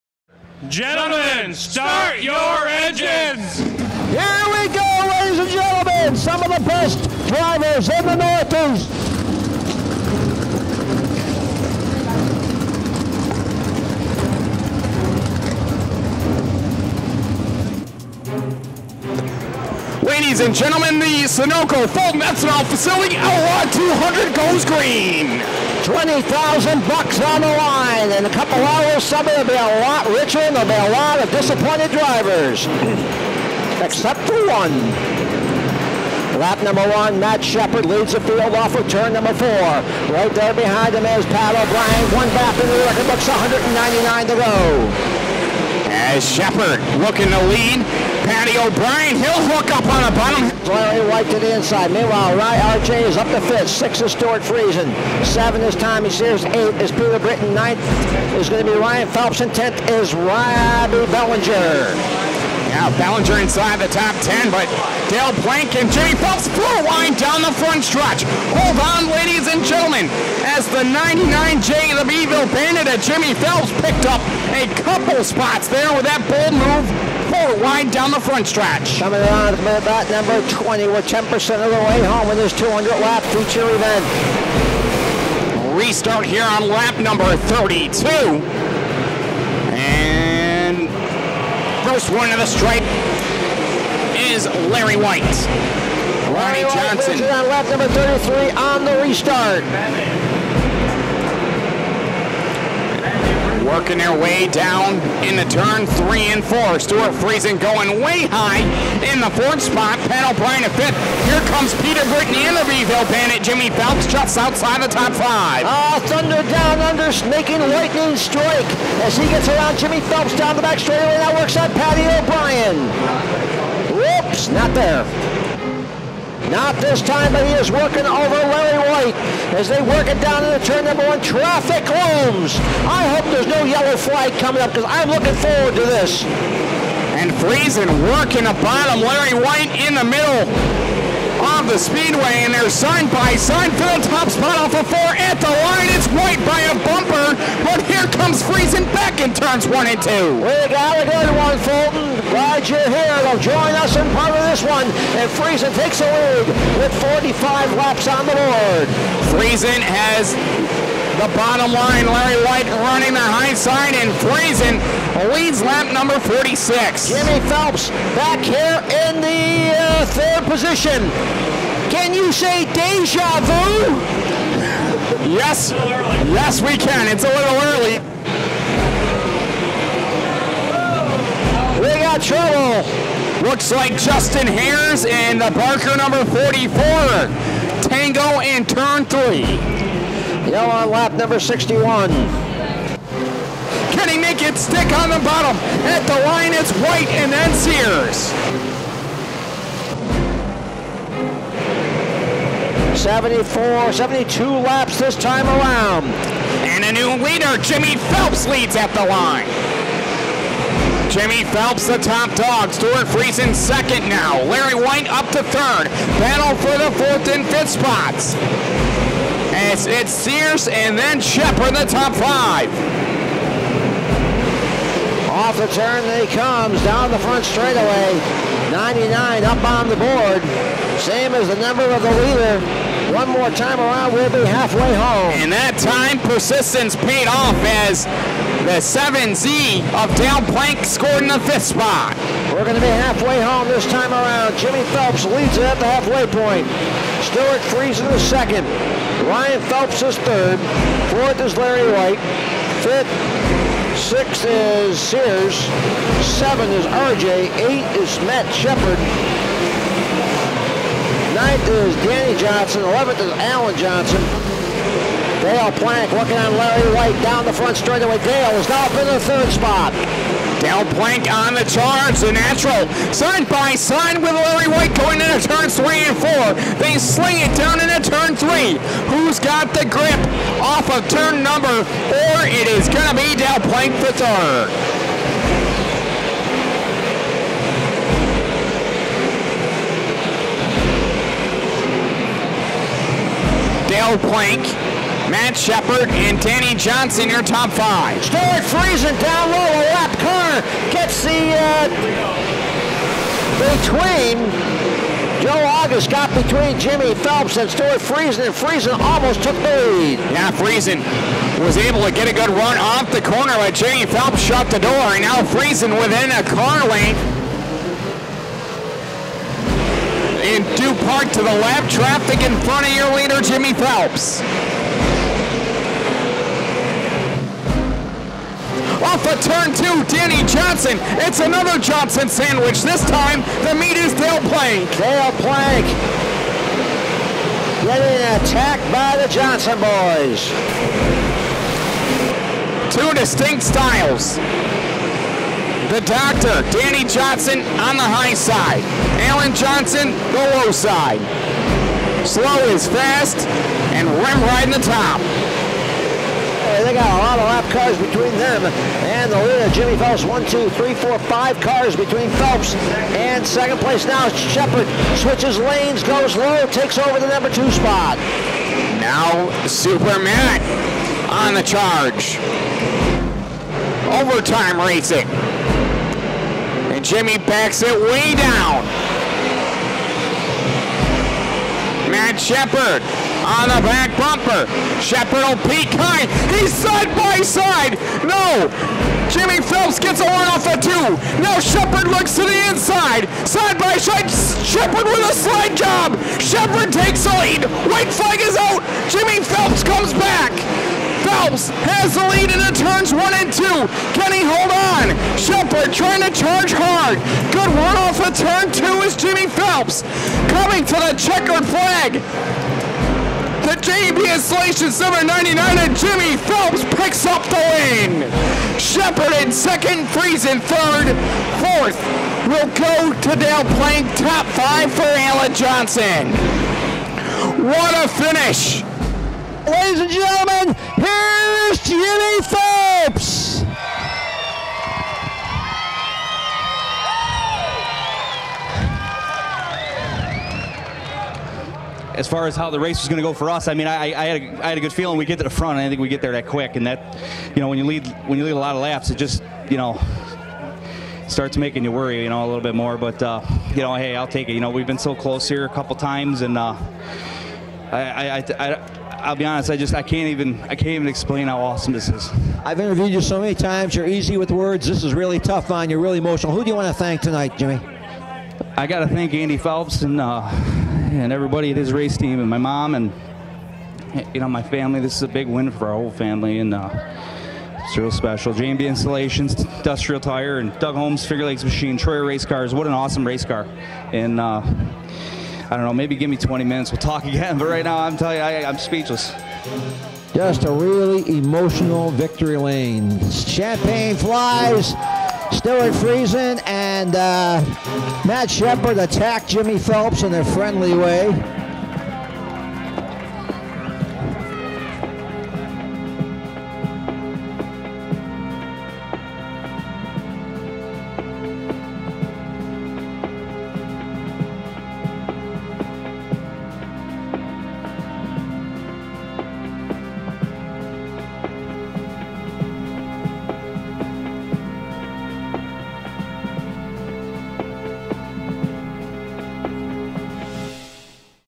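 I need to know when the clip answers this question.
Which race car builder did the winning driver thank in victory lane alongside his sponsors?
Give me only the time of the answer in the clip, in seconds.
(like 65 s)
481 s.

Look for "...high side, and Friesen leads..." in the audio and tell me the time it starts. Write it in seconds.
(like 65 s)
163 s.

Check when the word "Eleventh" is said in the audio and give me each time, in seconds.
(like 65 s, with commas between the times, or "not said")
262 s.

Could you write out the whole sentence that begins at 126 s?
Not this time, but he is working over Larry Wight as they work it down into turn number one.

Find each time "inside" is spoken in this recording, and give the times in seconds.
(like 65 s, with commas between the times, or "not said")
51 s, 63 s, 392 s.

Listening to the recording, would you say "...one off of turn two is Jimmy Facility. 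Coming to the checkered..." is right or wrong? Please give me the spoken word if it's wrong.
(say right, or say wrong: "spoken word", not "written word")
wrong: "Phelps", not "Facility".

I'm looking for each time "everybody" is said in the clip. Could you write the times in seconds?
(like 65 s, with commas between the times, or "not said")
471 s.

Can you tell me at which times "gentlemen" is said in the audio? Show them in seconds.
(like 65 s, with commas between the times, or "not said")
0 s, 5 s, 20 s, 69 s, 430 s.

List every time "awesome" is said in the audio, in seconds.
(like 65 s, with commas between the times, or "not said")
461 s, 482 s.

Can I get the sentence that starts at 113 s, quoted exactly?
Jimmy Phelps just outside the top five.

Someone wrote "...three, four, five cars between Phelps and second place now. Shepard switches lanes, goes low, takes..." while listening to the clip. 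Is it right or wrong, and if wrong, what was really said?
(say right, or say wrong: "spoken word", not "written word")
right.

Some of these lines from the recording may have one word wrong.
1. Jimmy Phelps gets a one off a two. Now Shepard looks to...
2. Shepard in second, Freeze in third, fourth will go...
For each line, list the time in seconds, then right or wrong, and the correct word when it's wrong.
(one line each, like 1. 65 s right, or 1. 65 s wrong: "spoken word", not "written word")
1. 389 s right
2. 418 s right.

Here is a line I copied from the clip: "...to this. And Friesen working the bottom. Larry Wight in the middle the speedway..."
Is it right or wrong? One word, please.
right.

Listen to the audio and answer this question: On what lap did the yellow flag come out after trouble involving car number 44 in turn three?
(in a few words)
61.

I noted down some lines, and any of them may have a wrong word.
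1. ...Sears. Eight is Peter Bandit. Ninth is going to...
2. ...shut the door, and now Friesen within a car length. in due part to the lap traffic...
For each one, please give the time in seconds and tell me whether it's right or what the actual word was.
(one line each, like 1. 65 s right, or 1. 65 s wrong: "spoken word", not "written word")
1. 56 s wrong: "Britton", not "Bandit"
2. 314 s right.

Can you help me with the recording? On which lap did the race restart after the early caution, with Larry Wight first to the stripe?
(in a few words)
32.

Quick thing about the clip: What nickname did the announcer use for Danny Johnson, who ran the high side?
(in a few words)
The doctor.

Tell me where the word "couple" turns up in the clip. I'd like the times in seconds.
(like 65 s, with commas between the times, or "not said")
28 s, 74 s, 455 s.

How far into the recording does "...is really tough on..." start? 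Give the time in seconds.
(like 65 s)
465 s.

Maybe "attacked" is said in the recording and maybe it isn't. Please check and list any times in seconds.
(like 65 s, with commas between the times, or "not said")
338 s, 498 s.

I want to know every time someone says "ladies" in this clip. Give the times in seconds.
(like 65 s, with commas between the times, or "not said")
5 s, 20 s, 69 s, 429 s.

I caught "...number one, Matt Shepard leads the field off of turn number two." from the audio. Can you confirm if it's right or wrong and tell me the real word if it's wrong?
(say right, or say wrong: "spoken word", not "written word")
wrong: "four", not "two".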